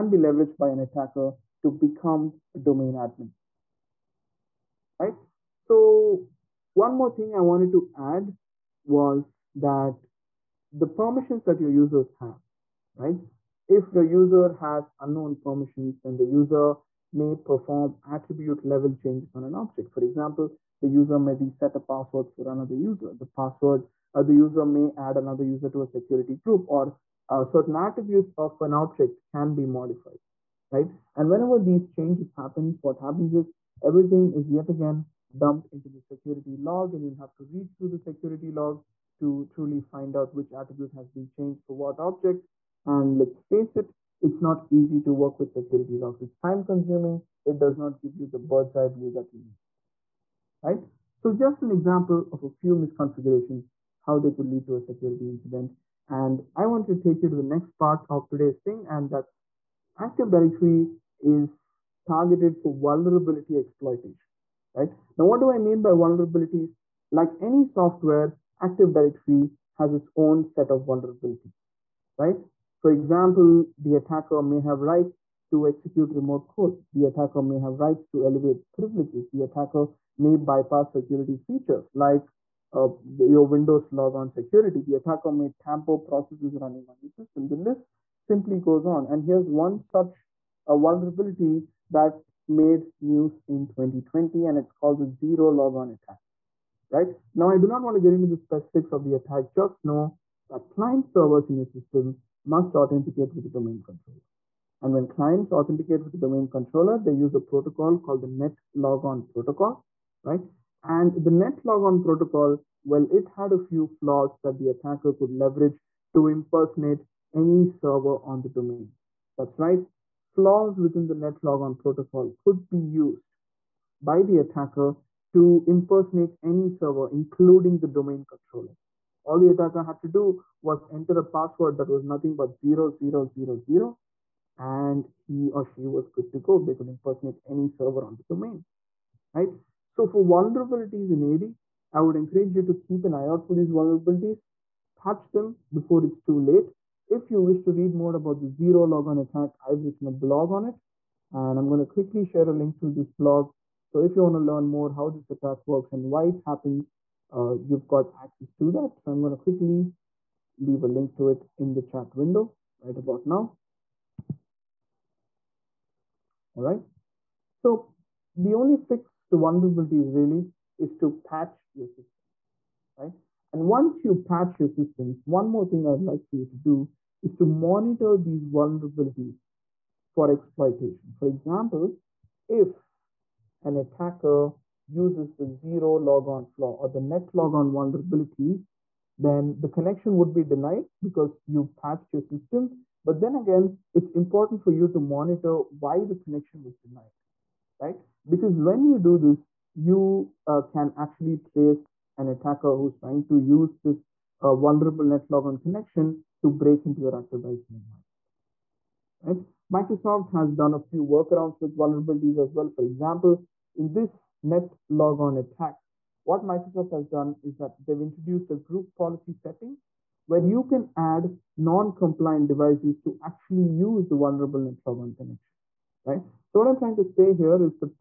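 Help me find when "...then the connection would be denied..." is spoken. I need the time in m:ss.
3:09.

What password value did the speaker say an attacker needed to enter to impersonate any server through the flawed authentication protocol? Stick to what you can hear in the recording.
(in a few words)
0000.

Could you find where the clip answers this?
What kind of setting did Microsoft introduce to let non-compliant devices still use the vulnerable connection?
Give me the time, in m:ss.
3:38.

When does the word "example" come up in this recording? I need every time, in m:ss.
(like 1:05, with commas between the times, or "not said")
0:20, 0:51, 1:12, 3:01, 3:32.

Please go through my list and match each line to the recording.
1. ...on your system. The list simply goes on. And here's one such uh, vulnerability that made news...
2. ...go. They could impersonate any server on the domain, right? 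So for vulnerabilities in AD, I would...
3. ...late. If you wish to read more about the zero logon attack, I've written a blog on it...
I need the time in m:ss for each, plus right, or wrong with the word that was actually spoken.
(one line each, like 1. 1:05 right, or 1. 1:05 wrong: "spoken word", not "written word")
1. 1:26 right
2. 2:16 right
3. 2:26 right.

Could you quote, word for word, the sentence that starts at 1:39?
Just know that client servers in your system must authenticate with the domain controller.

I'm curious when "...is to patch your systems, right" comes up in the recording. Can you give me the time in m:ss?
2:50.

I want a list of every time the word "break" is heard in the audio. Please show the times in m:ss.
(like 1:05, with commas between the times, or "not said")
3:26.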